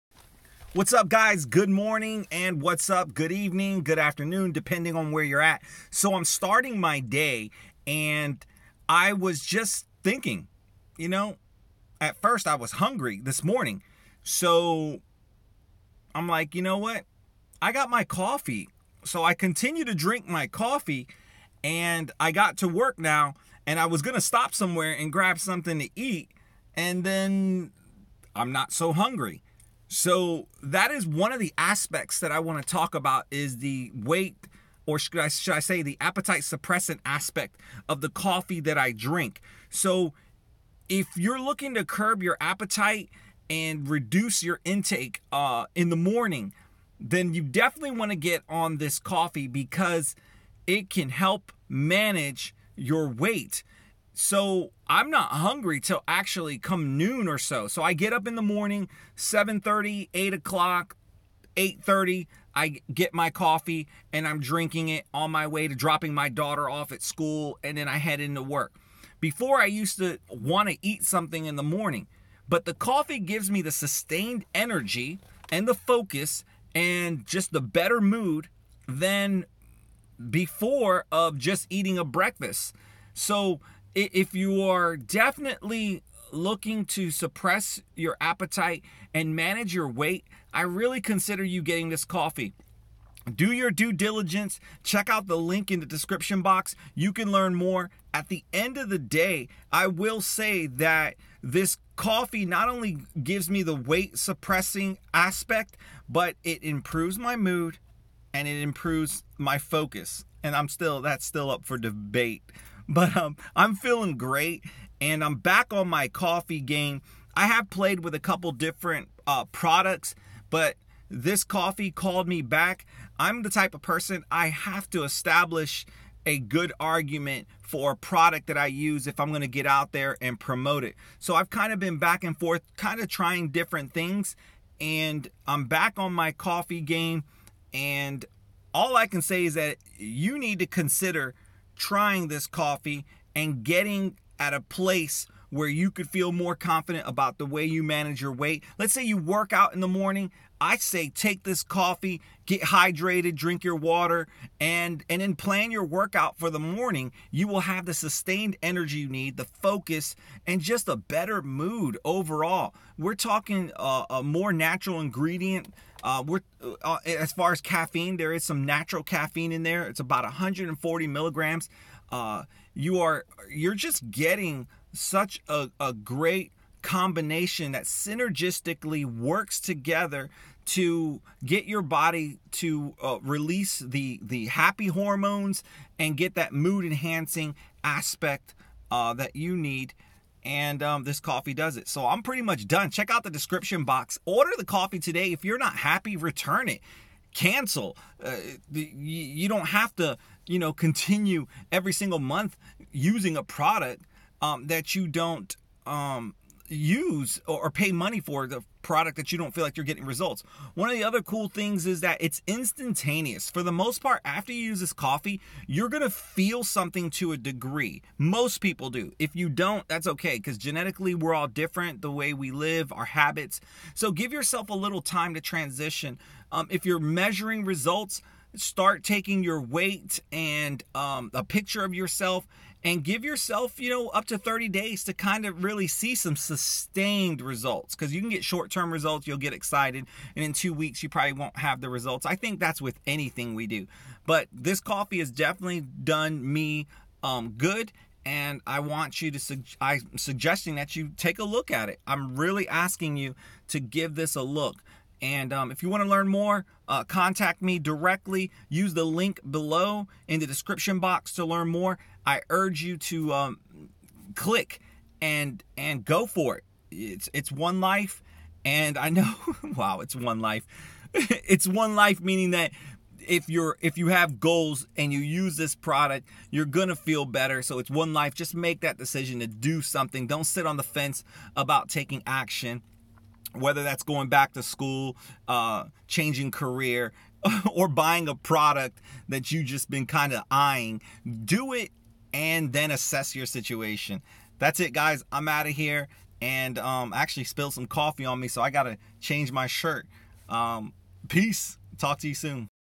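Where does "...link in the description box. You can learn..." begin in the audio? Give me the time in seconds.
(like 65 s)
95 s.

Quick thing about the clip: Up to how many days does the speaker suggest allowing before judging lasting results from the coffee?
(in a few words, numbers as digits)
30 days.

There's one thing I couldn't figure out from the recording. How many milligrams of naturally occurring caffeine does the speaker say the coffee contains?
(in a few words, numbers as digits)
140 milligrams.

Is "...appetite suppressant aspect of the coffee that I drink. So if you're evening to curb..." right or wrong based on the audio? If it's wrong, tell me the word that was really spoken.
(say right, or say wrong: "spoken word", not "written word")
wrong: "looking", not "evening".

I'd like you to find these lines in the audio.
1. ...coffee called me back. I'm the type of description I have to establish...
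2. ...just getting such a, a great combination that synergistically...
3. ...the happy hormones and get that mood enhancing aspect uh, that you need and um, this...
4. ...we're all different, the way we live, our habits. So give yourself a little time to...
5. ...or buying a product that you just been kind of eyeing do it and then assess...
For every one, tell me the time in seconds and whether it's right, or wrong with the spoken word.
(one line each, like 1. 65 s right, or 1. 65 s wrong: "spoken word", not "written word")
1. 121 s wrong: "person", not "description"
2. 173 s right
3. 184 s right
4. 221 s right
5. 287 s right.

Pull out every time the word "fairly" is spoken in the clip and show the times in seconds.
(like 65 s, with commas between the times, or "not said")
not said.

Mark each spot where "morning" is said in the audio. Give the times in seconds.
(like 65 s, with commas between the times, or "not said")
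1 s, 13 s, 45 s, 58 s, 71 s, 149 s, 156 s.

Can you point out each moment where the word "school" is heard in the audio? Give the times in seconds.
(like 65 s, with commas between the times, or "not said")
67 s, 284 s.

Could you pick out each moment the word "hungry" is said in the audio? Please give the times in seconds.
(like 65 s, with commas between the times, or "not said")
12 s, 28 s, 55 s.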